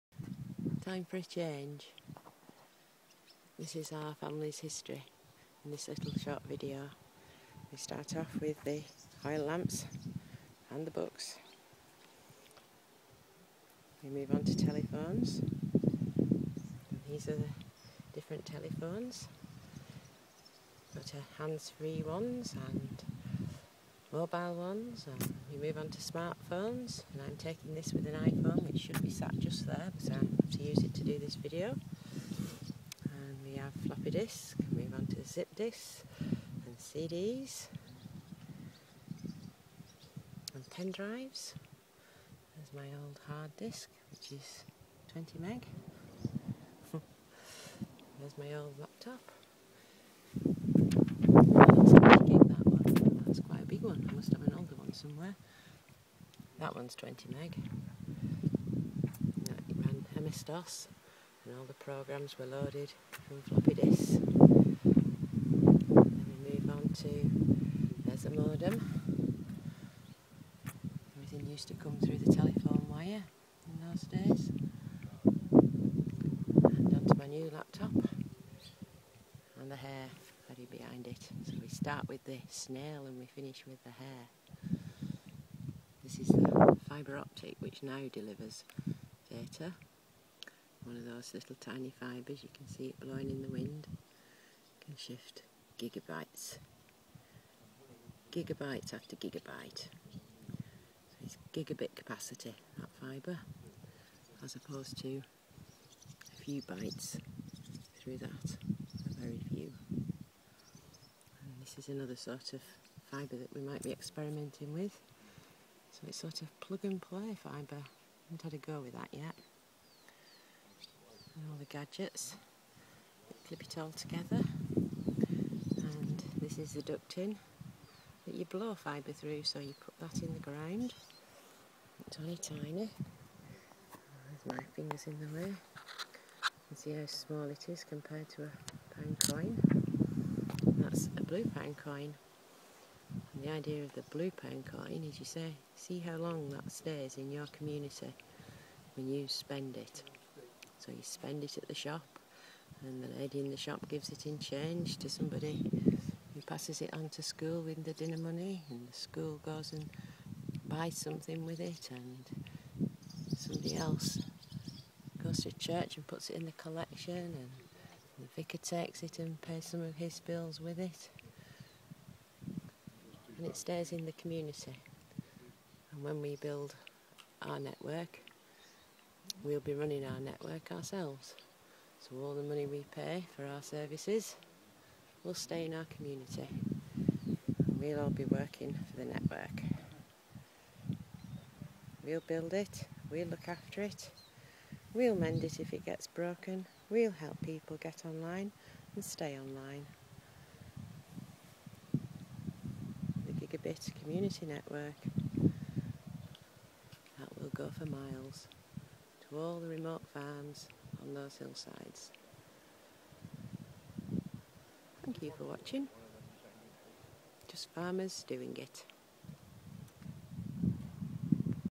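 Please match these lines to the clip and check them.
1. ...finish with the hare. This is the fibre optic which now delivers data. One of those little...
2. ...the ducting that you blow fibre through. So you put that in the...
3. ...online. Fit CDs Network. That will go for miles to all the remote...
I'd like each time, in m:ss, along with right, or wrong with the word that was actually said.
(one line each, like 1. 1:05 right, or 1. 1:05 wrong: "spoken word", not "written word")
1. 1:23 right
2. 2:06 right
3. 3:19 wrong: "Community", not "CDs".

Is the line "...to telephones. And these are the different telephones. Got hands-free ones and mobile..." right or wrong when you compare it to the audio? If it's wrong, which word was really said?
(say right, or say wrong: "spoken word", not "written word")
right.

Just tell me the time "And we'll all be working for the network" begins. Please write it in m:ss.
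3:07.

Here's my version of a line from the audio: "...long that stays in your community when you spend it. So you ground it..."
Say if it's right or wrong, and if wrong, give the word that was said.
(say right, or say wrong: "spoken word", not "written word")
wrong: "spend", not "ground".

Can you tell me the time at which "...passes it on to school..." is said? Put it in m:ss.
2:36.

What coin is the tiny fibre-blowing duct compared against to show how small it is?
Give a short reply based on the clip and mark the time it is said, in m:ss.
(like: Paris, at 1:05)
a pound coin, at 2:18.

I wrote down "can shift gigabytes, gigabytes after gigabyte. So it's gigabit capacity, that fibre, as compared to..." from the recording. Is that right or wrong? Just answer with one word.
wrong.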